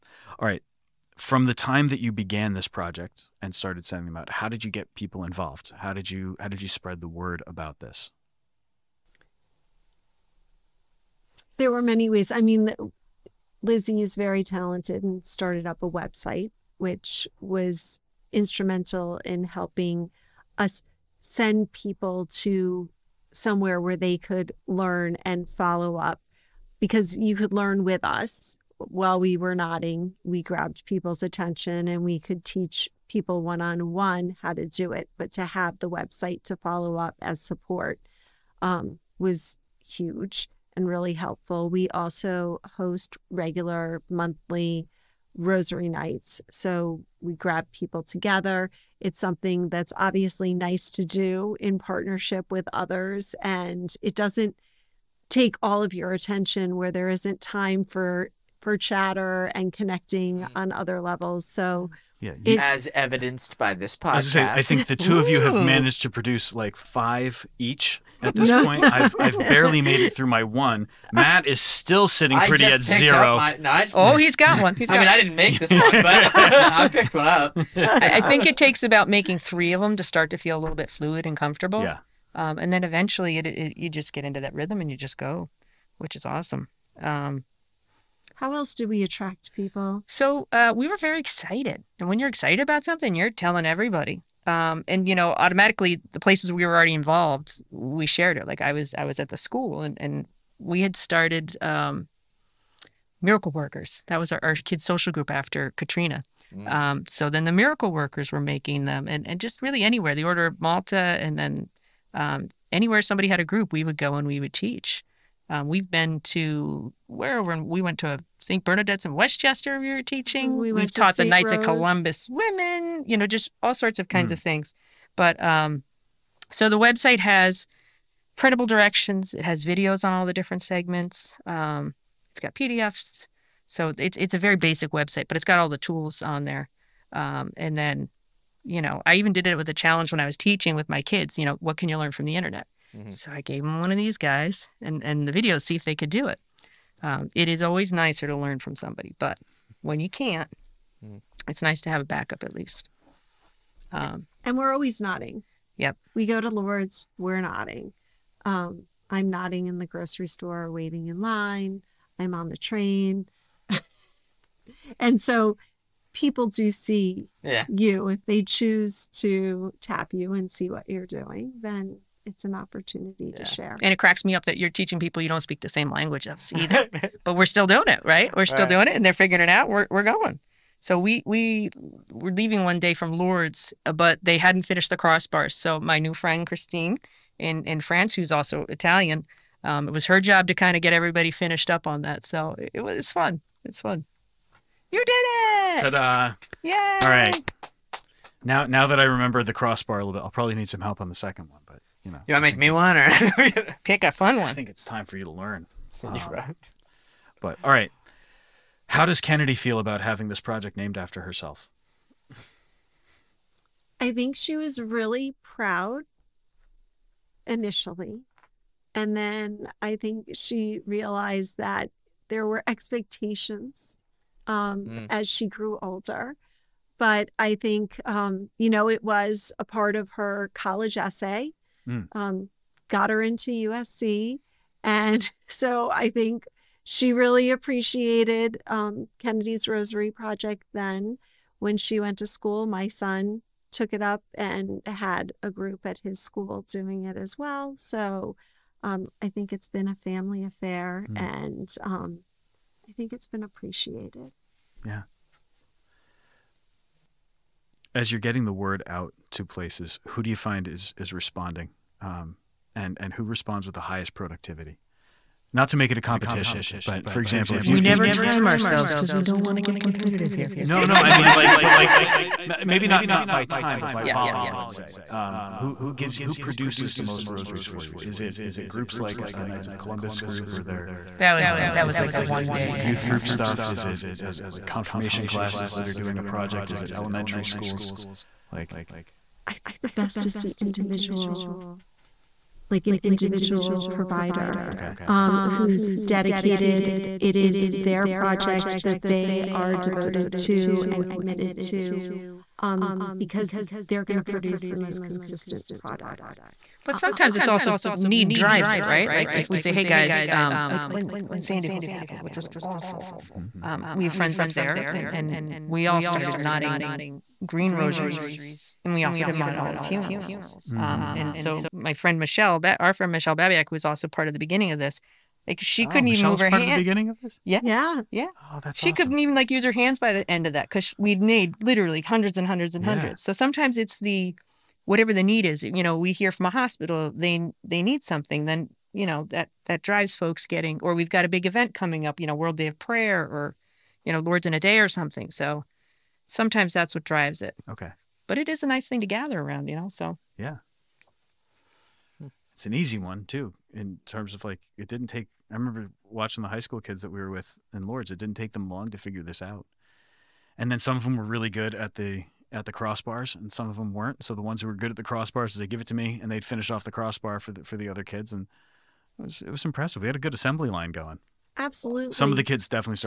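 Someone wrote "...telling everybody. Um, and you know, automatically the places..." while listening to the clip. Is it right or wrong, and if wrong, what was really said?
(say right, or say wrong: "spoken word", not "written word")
right.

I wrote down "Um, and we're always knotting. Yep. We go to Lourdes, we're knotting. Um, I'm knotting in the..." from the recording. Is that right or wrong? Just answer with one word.
right.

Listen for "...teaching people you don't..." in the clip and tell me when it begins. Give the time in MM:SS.
02:54.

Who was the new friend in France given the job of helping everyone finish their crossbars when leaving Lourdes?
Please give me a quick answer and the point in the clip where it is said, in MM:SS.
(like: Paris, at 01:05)
Christine, at 03:06.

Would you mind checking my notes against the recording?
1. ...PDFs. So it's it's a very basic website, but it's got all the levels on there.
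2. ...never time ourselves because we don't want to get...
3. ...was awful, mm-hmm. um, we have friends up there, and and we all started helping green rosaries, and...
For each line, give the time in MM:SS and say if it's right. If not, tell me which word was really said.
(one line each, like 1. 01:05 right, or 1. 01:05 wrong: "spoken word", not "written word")
1. 02:12 wrong: "tools", not "levels"
2. 04:27 right
3. 05:12 wrong: "knotting", not "helping".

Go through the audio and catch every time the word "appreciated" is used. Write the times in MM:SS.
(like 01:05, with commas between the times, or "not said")
03:57, 04:13.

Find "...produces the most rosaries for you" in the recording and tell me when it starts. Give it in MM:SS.
04:36.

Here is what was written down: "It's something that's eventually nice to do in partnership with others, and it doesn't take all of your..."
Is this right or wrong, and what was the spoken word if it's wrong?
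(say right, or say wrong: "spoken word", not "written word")
wrong: "obviously", not "eventually".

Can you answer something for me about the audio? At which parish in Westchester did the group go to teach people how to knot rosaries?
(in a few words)
St. Bernadette's.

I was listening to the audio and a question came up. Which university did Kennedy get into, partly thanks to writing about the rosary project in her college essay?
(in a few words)
USC.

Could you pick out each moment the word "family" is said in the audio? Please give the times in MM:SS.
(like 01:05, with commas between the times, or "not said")
04:09.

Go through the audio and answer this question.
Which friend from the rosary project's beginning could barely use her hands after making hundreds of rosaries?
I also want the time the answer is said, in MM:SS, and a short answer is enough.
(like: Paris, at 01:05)
Michelle Babiak, at 05:23.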